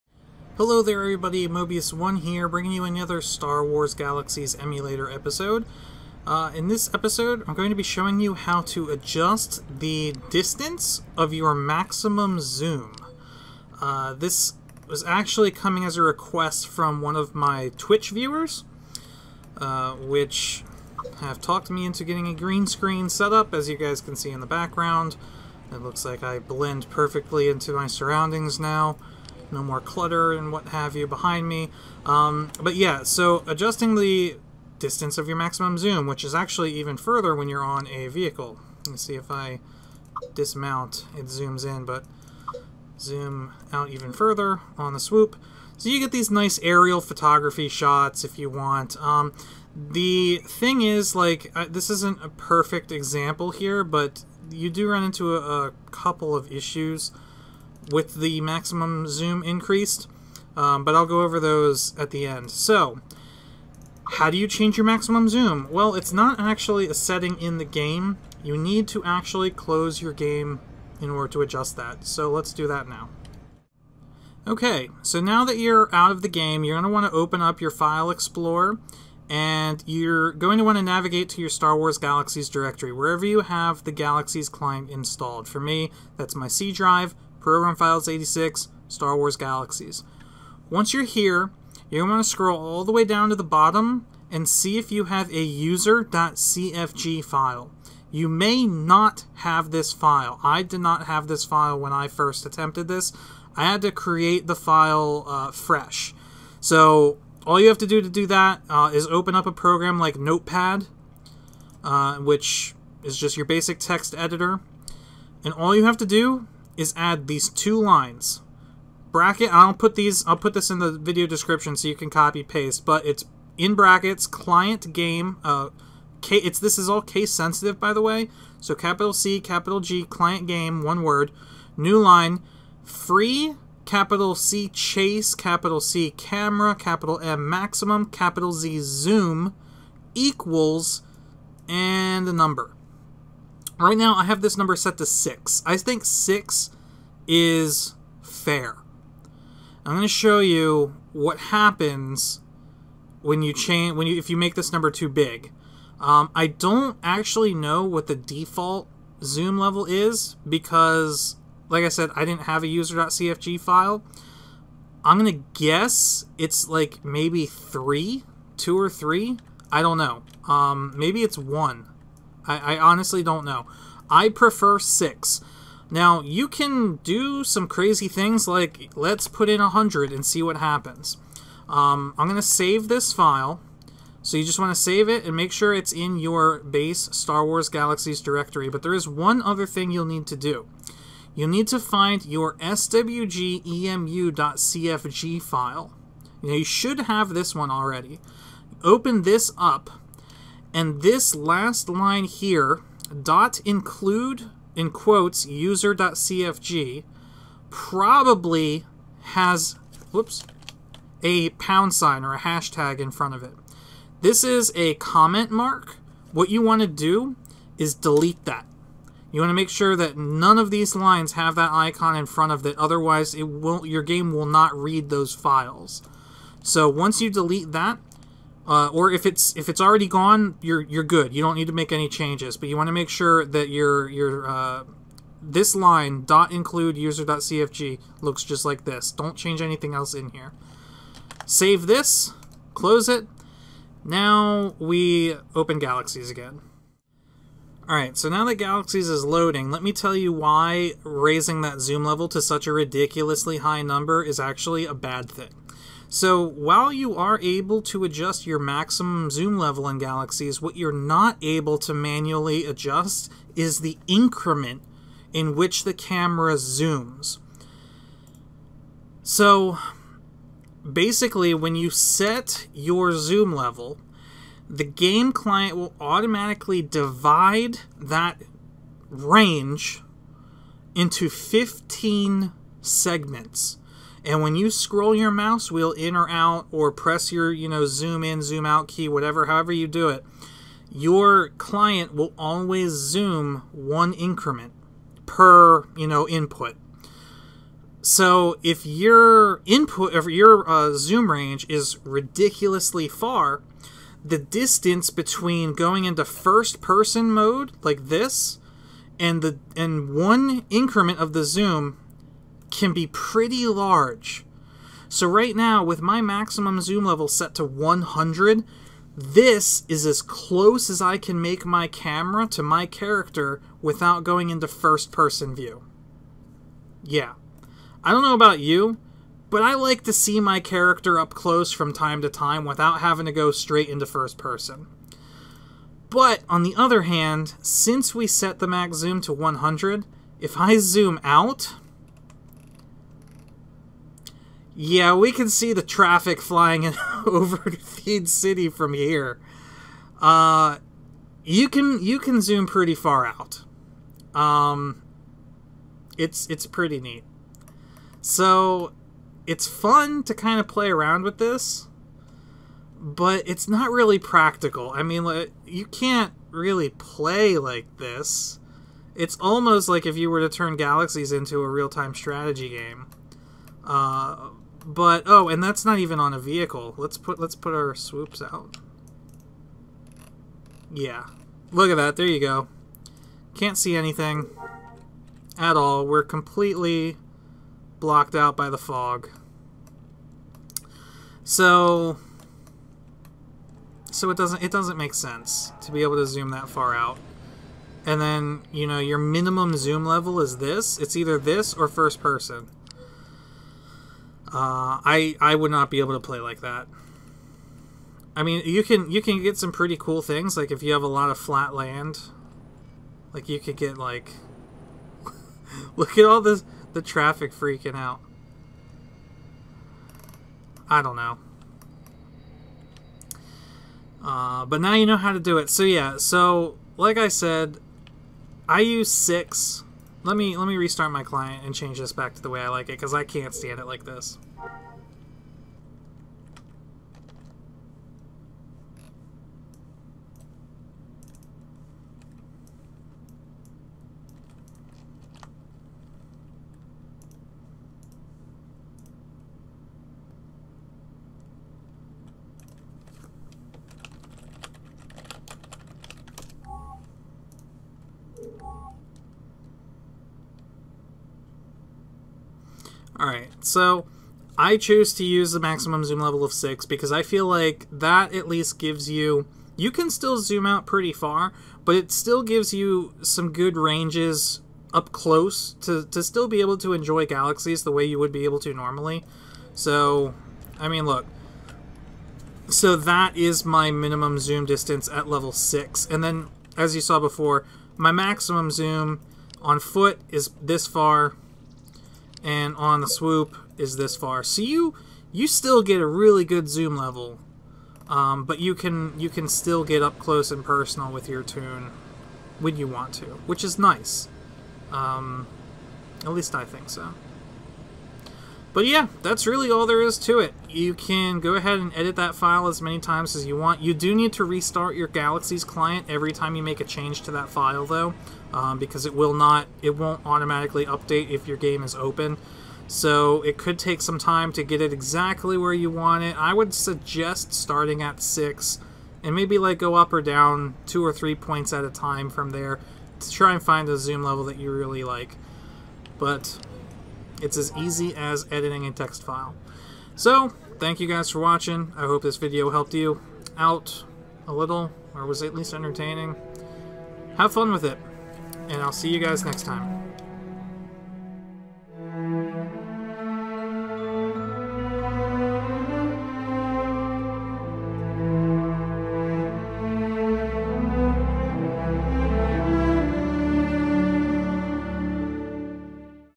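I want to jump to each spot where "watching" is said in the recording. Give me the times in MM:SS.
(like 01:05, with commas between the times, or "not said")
09:01.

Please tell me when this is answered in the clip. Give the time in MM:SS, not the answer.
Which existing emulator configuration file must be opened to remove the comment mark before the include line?
03:12.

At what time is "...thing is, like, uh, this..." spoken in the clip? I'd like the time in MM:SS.
00:50.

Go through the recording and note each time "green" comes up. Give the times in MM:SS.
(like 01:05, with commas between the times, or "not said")
00:22.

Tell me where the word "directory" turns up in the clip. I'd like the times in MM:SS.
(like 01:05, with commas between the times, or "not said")
01:22, 03:08.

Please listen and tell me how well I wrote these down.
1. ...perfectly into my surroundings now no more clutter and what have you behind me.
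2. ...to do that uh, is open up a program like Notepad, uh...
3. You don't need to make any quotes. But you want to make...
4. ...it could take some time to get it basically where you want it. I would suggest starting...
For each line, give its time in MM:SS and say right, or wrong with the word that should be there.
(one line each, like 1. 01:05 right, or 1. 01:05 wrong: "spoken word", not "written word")
1. 00:26 right
2. 01:48 right
3. 03:51 wrong: "changes", not "quotes"
4. 08:43 wrong: "exactly", not "basically".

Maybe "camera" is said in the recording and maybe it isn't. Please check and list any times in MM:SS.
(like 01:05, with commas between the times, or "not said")
02:16, 04:25, 05:21.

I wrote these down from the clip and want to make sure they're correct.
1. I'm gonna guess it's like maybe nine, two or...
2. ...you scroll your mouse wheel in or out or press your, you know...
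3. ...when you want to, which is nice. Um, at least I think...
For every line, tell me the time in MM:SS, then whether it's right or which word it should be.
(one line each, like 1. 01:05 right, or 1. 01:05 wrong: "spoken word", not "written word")
1. 02:45 wrong: "three", not "nine"
2. 04:44 right
3. 08:22 right.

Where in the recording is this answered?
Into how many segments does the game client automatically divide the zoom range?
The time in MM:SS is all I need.
04:41.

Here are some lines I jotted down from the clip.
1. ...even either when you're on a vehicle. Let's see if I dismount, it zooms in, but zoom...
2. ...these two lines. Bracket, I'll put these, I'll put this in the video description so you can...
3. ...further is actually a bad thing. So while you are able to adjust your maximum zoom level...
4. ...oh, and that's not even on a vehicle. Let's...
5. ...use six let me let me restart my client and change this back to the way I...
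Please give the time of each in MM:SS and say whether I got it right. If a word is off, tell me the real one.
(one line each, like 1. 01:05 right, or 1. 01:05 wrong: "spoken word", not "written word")
1. 00:36 wrong: "further", not "either"
2. 01:57 right
3. 04:13 wrong: "number", not "further"
4. 06:15 right
5. 07:08 right.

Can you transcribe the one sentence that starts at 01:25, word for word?
For me, that's my C drive.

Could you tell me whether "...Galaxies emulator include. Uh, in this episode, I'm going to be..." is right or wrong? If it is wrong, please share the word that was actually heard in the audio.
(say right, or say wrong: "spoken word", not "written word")
wrong: "episode", not "include".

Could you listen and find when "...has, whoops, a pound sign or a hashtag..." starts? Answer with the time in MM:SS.
03:29.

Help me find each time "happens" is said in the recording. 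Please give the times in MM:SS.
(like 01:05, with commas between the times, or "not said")
02:31, 03:00.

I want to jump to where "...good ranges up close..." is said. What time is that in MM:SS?
07:53.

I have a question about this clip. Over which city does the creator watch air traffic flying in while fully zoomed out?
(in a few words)
Theed City.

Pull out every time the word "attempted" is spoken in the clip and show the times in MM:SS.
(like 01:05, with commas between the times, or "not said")
01:42.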